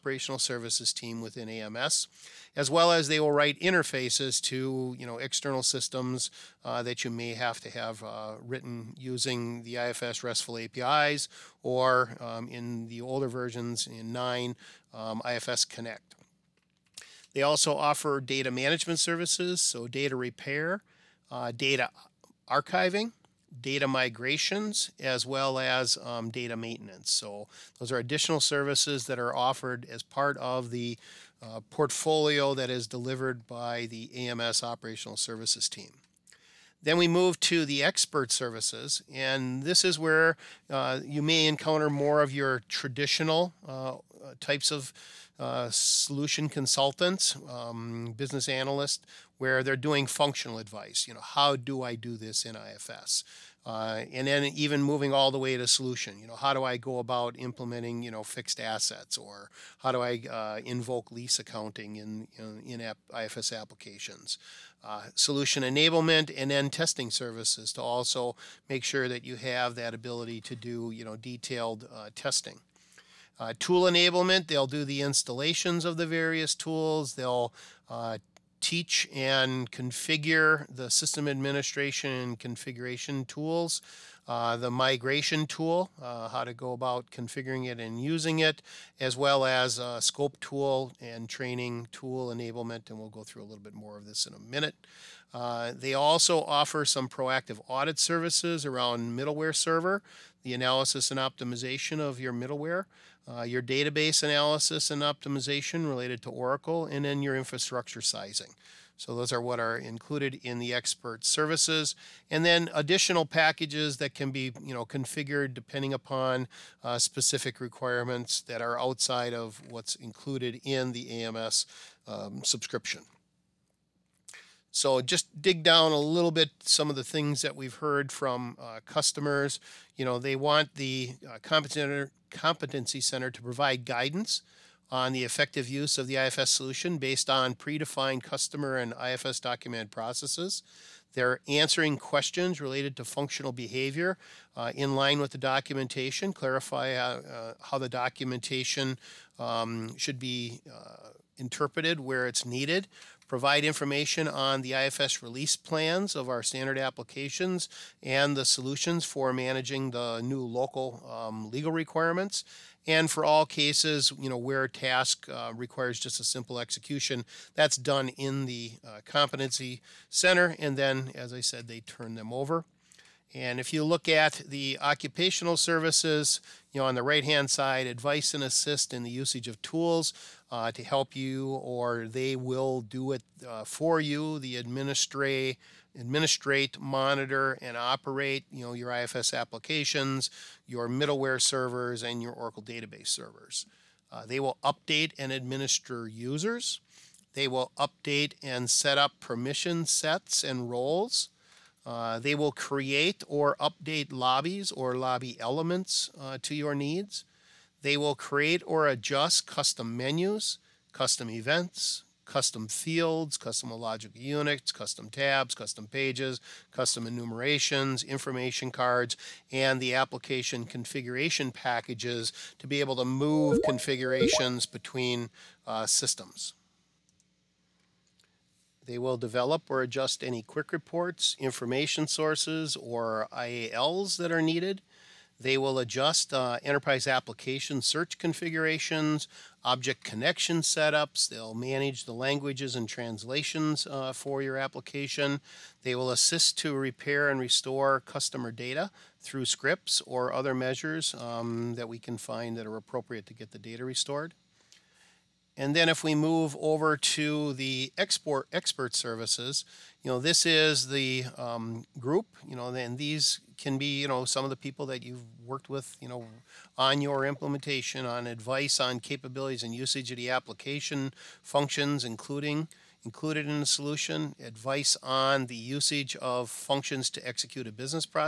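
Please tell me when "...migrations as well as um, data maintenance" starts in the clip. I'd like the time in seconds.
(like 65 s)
23 s.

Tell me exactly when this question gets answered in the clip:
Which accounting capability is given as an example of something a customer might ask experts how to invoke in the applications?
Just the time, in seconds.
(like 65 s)
61 s.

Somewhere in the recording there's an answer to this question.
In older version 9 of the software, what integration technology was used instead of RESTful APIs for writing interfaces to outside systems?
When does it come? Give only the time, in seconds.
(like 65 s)
15 s.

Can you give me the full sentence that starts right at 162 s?
And for all cases, you know, where a task uh, requires just a simple execution, that's done in the uh, competency center.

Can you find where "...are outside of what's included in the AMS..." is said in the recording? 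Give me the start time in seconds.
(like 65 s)
118 s.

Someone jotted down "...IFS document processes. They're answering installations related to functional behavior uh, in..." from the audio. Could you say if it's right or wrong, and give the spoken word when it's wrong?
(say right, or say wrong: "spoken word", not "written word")
wrong: "questions", not "installations".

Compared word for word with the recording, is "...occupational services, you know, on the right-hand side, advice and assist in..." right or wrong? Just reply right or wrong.
right.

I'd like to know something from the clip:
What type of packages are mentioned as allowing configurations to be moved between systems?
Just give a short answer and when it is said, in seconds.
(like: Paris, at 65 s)
application configuration packages, at 219 s.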